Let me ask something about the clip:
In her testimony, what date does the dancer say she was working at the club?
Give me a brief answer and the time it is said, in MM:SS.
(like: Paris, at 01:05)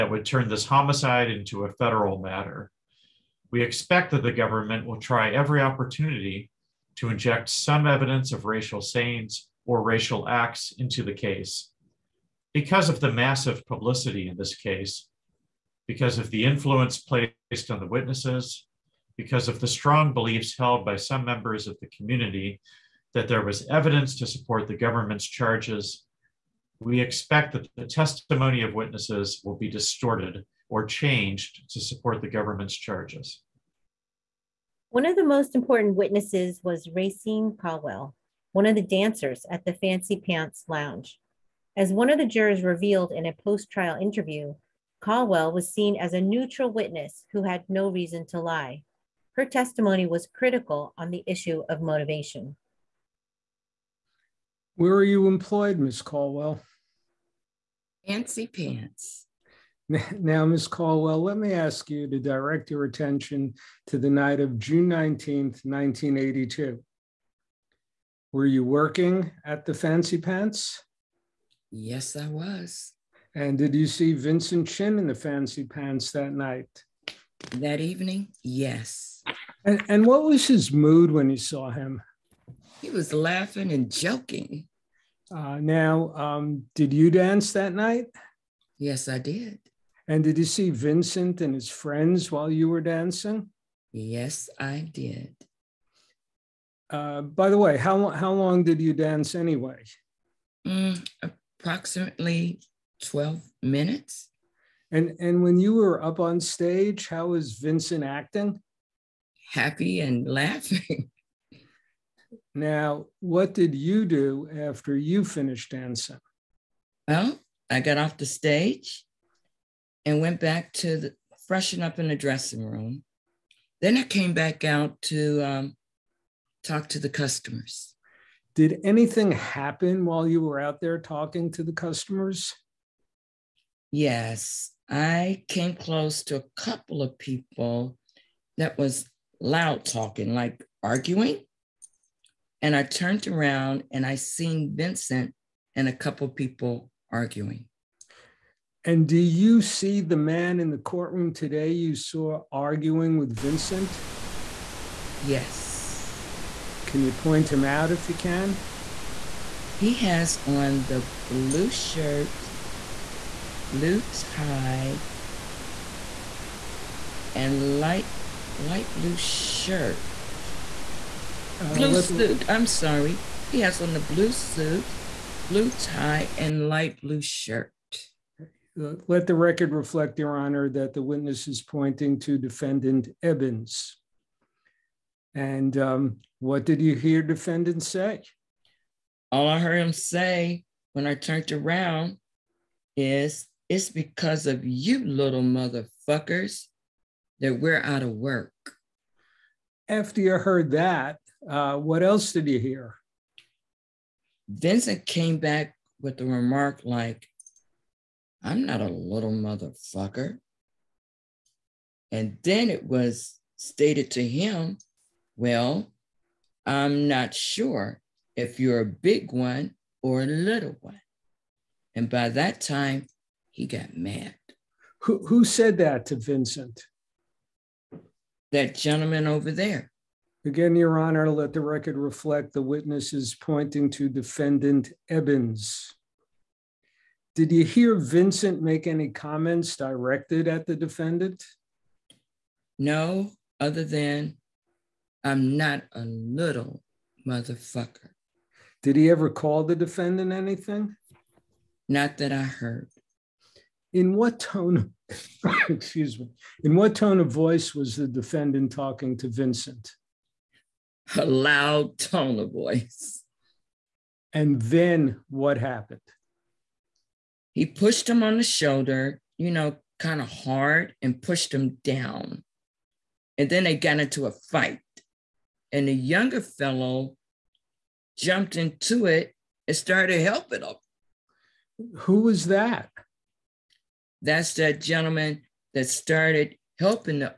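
June 19th, 1982, at 01:04.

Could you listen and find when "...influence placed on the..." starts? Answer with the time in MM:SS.
00:16.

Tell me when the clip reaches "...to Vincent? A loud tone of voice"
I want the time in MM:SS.
04:19.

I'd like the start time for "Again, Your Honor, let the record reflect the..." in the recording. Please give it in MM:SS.
03:50.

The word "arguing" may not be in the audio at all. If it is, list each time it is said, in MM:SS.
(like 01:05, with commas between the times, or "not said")
02:20, 02:27, 02:32.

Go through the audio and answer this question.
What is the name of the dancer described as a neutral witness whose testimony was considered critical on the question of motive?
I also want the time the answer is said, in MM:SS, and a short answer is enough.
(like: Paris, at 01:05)
Racine Caldwell, at 00:36.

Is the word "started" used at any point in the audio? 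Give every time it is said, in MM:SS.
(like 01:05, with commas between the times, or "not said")
04:39, 04:45.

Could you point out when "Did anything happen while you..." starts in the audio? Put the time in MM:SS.
02:08.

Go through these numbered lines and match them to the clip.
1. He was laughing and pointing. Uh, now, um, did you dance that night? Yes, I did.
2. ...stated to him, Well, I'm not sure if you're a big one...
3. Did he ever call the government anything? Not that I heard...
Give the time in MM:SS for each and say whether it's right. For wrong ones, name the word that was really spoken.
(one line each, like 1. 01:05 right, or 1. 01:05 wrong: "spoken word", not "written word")
1. 01:22 wrong: "joking", not "pointing"
2. 03:33 right
3. 04:08 wrong: "defendant", not "government".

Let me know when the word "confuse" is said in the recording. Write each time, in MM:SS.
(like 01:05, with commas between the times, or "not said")
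not said.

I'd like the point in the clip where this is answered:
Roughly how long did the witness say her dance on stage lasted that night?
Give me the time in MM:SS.
01:43.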